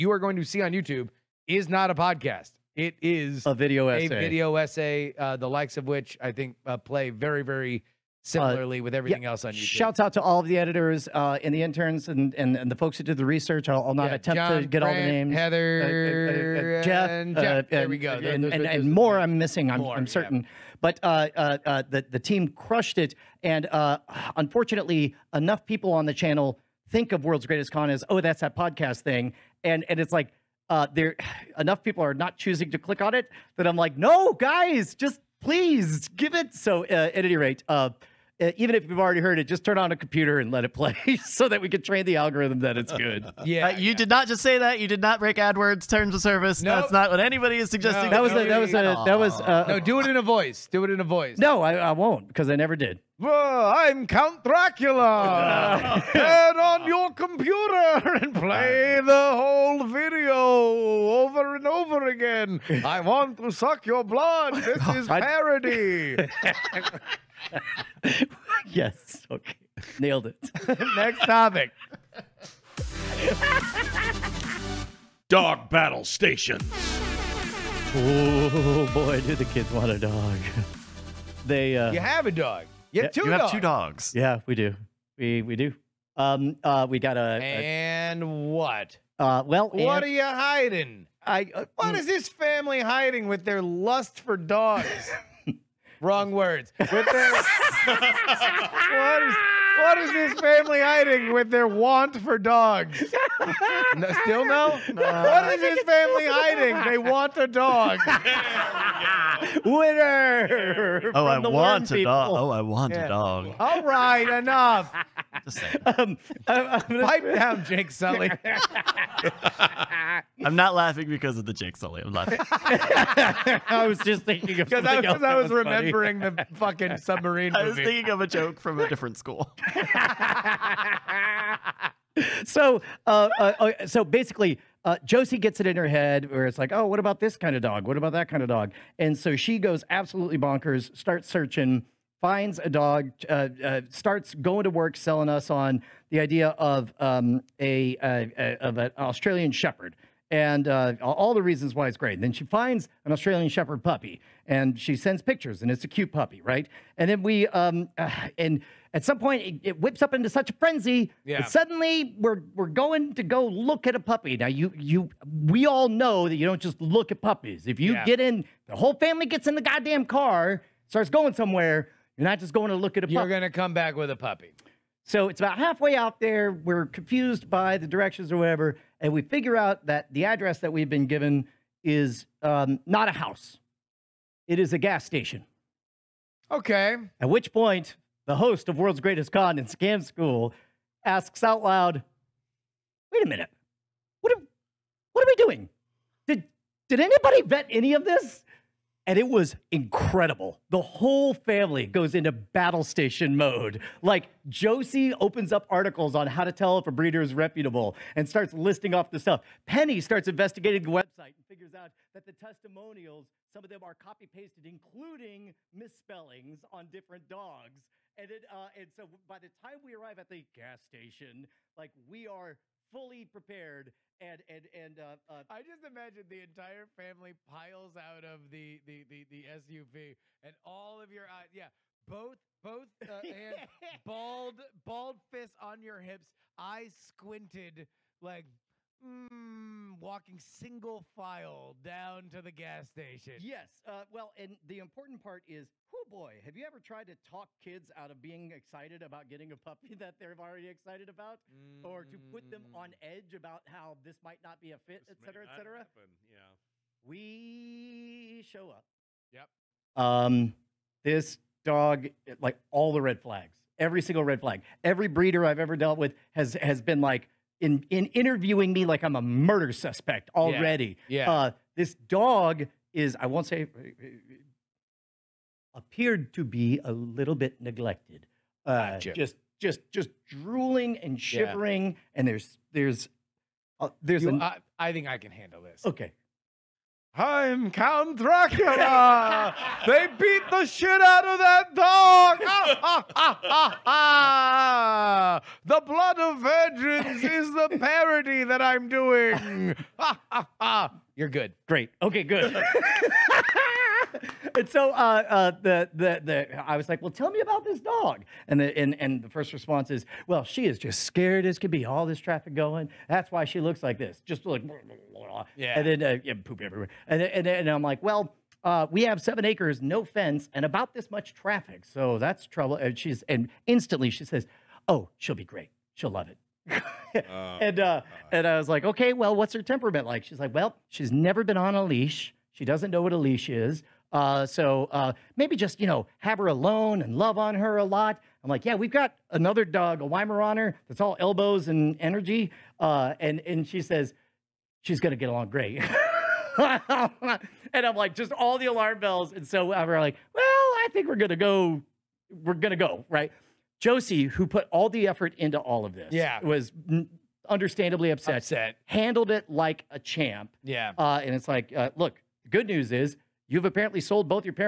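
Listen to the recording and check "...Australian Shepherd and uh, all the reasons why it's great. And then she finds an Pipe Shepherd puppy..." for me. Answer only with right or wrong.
wrong.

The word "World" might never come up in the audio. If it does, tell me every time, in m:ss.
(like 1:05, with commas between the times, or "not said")
0:27, 3:08.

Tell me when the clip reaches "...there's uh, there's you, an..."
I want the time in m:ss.
4:42.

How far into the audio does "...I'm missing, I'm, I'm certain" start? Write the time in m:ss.
0:19.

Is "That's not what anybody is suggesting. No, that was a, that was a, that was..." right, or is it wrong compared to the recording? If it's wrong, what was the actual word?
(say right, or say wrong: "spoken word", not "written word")
right.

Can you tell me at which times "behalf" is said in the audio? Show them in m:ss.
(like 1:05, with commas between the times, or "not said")
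not said.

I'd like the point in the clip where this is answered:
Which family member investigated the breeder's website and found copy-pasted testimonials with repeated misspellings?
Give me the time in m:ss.
3:29.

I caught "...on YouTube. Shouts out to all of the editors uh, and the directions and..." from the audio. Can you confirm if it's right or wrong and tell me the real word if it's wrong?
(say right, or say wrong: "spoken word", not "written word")
wrong: "interns", not "directions".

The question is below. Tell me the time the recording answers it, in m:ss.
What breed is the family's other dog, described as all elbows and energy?
5:40.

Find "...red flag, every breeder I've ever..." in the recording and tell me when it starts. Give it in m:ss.
4:24.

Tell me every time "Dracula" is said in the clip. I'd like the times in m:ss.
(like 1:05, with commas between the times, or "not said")
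0:54, 4:48.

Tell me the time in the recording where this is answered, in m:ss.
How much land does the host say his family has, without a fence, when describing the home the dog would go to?
5:19.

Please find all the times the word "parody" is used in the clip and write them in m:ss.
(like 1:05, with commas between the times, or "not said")
1:05, 4:57.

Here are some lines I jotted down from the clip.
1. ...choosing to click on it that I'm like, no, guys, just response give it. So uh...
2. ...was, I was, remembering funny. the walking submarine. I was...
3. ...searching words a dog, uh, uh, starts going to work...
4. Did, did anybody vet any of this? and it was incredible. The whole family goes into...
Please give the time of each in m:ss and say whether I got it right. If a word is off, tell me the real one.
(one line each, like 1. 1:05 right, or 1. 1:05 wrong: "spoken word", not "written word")
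1. 0:32 wrong: "please", not "response"
2. 2:04 wrong: "fucking", not "walking"
3. 2:21 wrong: "finds", not "words"
4. 3:16 right.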